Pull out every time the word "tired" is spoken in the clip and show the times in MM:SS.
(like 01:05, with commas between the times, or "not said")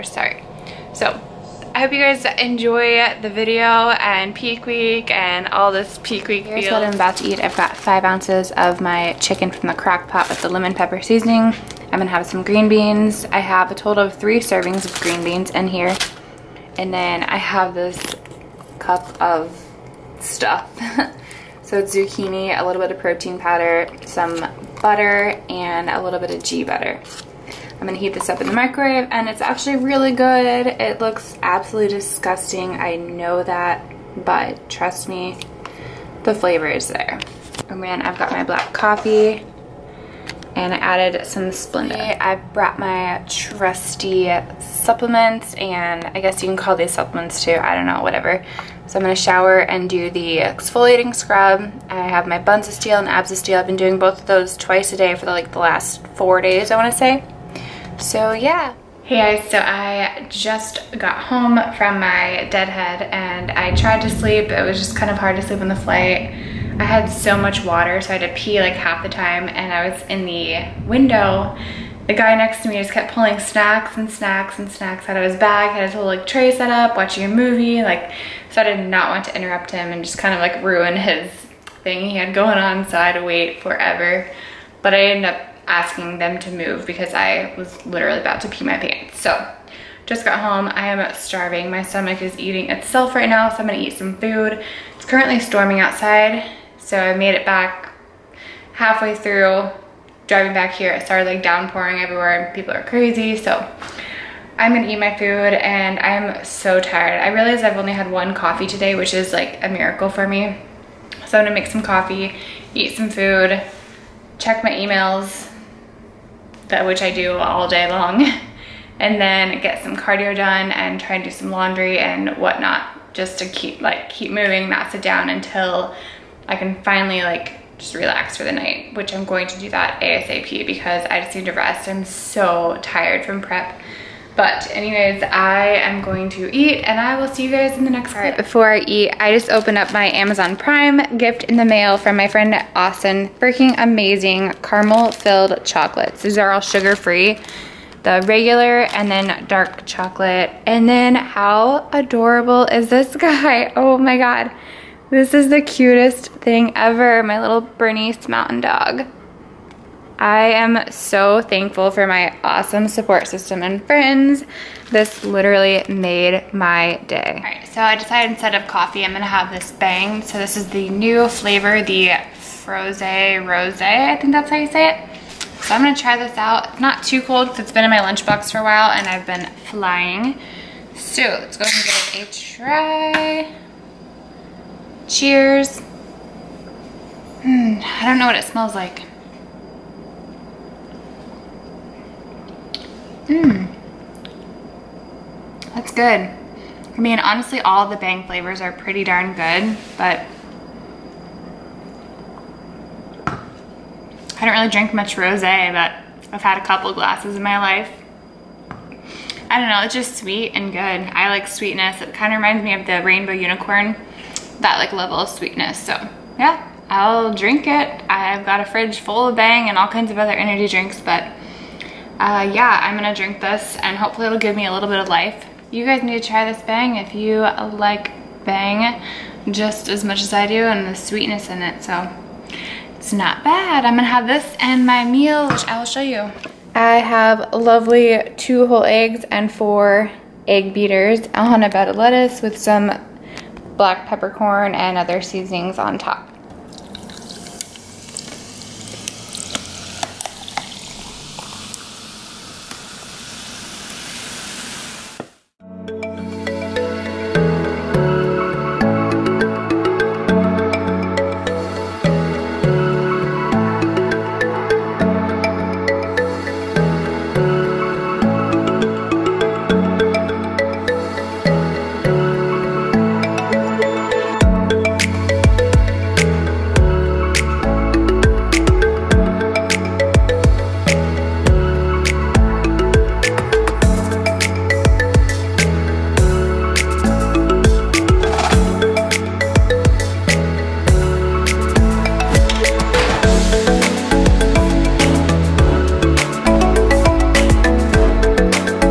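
01:46, 02:12.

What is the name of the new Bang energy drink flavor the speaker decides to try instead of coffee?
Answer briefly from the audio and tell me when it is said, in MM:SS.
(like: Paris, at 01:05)
Frosé Rosé, at 02:52.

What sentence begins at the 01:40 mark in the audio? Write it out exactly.
It started like downpouring everywhere and people are crazy.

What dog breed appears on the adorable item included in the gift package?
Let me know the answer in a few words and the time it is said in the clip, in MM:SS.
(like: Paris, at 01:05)
Bernese mountain dog, at 02:37.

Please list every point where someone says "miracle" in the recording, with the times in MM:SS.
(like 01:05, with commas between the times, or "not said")
01:49.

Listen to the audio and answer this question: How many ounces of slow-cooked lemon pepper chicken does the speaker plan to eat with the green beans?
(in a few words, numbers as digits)
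5.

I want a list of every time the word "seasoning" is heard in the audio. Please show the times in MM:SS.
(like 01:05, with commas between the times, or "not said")
00:11, 04:05.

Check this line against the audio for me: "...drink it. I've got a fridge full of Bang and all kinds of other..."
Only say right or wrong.
right.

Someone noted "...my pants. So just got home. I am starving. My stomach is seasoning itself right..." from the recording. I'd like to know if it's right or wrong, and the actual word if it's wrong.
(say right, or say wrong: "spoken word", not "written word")
wrong: "eating", not "seasoning".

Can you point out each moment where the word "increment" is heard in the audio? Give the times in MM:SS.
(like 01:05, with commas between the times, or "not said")
not said.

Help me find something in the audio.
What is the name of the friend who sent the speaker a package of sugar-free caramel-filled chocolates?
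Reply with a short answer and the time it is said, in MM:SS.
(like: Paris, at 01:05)
Austin, at 02:22.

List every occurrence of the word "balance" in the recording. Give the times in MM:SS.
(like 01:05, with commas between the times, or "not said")
not said.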